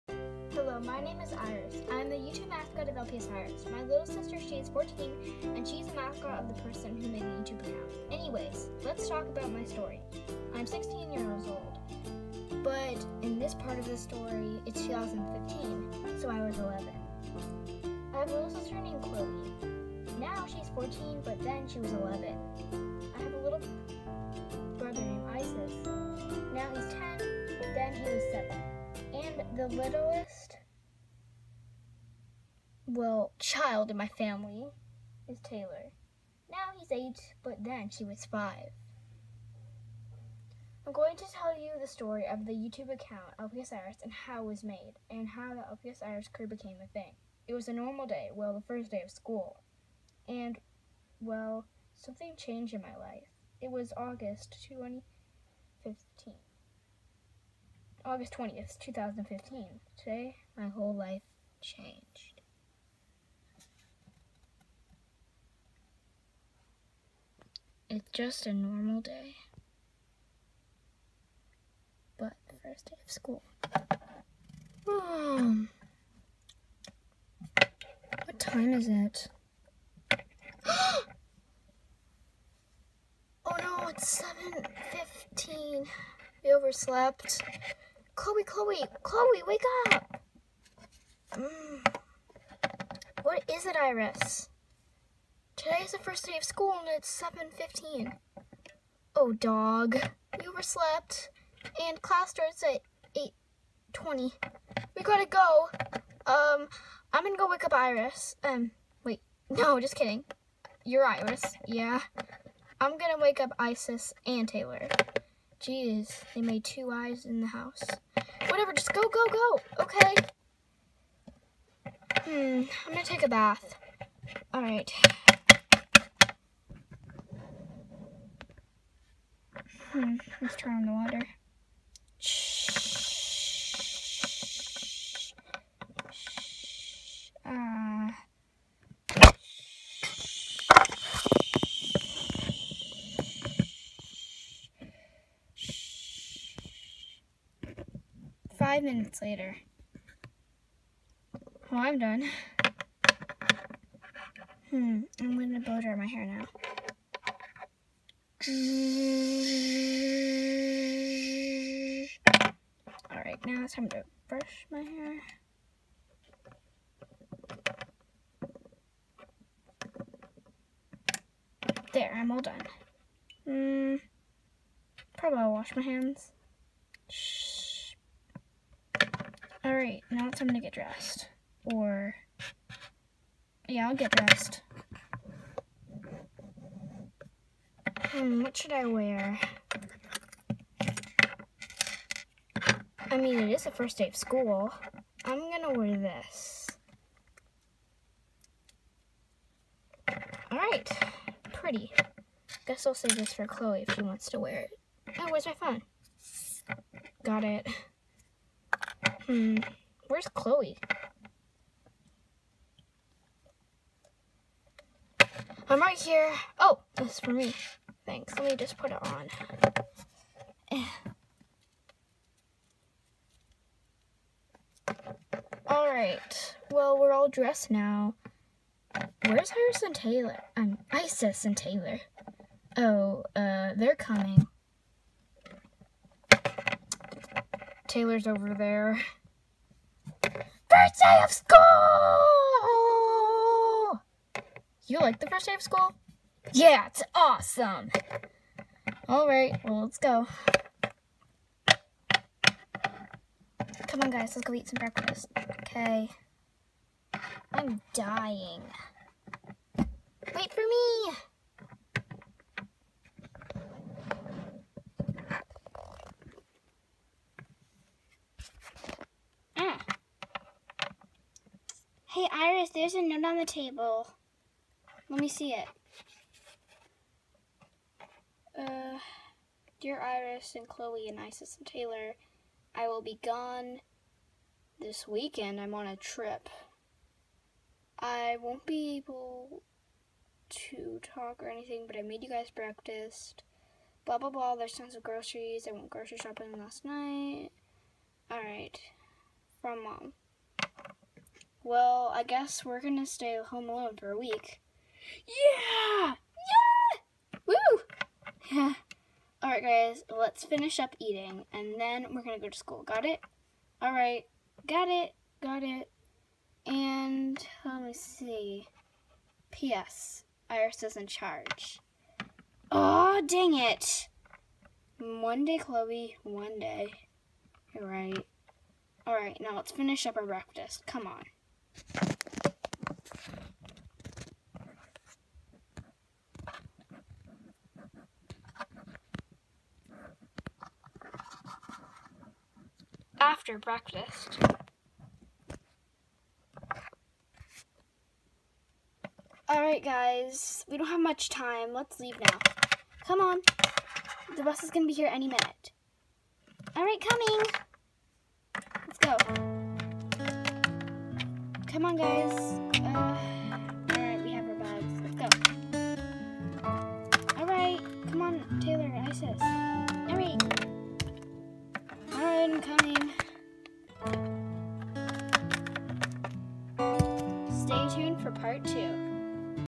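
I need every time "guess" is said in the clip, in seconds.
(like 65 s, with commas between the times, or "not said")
202 s, 302 s.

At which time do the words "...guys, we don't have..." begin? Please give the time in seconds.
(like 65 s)
349 s.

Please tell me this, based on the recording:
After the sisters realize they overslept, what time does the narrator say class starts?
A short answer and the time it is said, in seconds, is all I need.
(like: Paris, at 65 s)
8:20, at 103 s.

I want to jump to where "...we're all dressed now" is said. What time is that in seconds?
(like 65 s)
226 s.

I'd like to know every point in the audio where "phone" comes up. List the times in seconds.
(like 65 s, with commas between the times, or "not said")
205 s.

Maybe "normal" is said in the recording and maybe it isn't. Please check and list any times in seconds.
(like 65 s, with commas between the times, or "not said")
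47 s, 68 s.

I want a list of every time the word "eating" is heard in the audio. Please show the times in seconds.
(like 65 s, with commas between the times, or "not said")
310 s.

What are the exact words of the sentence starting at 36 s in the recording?
Now he's eight, but then he was five.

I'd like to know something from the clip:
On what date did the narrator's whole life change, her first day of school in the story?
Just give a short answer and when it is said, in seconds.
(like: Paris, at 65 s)
August 20th, 2015, at 58 s.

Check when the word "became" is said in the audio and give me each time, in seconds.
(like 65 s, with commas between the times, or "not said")
46 s.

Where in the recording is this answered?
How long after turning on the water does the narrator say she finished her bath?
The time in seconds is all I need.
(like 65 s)
148 s.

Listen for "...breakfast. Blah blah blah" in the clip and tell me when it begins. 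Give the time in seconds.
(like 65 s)
292 s.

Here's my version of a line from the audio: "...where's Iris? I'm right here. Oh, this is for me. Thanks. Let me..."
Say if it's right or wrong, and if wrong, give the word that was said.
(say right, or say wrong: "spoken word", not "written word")
wrong: "Chloe", not "Iris".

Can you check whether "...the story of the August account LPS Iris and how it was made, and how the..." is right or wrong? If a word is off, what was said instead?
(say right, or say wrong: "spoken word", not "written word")
wrong: "YouTube", not "August".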